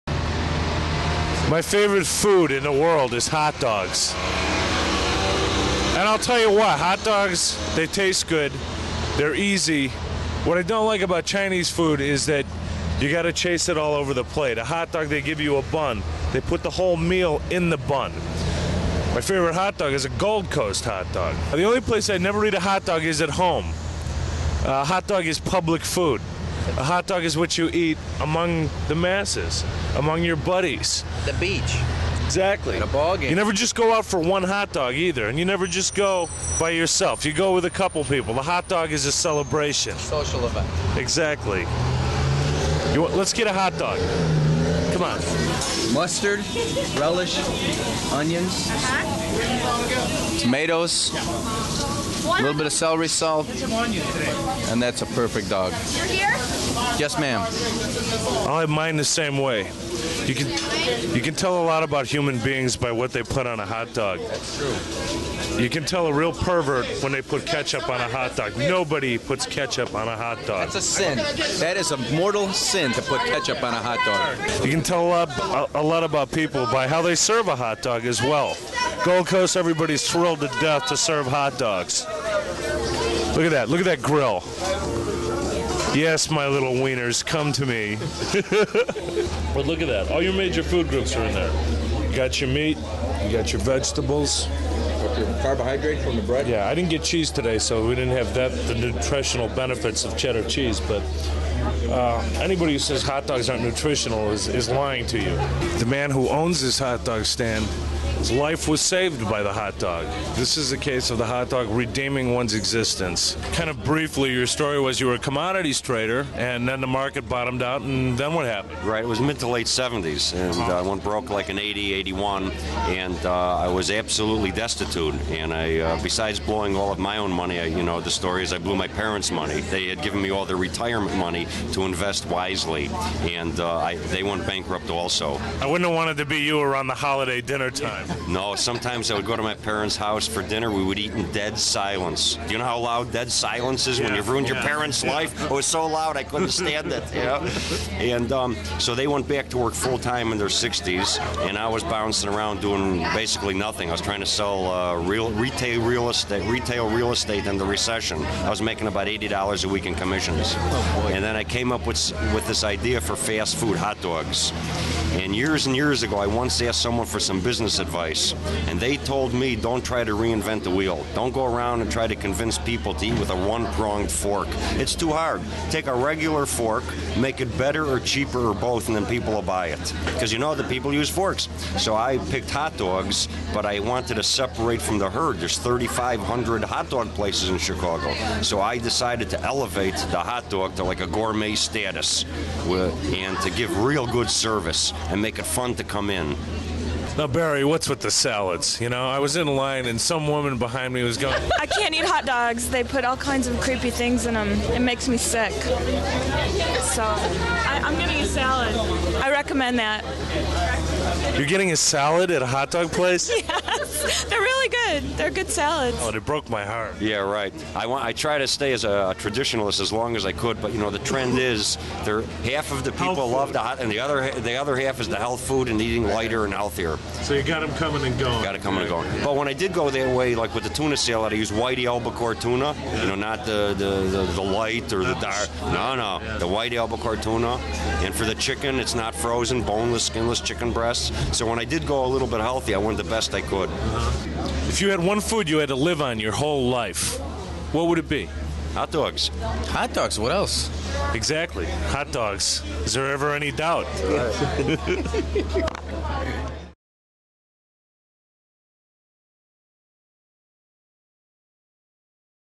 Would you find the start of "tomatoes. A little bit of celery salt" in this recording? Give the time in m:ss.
0:50.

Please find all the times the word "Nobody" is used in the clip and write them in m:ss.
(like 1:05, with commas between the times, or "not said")
1:08.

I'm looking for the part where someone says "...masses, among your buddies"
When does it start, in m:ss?
0:28.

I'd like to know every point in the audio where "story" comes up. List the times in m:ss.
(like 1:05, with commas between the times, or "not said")
1:54, 2:08.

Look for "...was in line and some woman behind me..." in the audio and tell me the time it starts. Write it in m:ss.
3:19.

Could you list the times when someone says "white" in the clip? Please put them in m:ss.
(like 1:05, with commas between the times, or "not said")
3:51, 3:56.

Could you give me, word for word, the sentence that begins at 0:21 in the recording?
The only place I never eat a hot dog is at home.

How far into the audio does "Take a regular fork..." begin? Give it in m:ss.
2:55.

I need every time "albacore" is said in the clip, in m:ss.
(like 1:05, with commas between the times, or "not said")
3:51, 3:56.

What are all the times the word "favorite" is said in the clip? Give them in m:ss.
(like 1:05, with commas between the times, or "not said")
0:01, 0:19.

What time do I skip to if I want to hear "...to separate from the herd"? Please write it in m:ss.
3:04.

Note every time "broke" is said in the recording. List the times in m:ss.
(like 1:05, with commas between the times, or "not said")
2:01, 3:36.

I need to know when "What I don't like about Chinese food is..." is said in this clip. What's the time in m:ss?
0:10.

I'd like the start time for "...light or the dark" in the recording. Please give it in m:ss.
3:54.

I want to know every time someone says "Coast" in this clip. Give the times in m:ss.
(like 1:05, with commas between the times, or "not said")
0:20, 1:19.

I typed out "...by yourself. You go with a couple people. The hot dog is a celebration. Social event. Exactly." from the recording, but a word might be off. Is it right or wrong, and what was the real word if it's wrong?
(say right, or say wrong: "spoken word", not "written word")
right.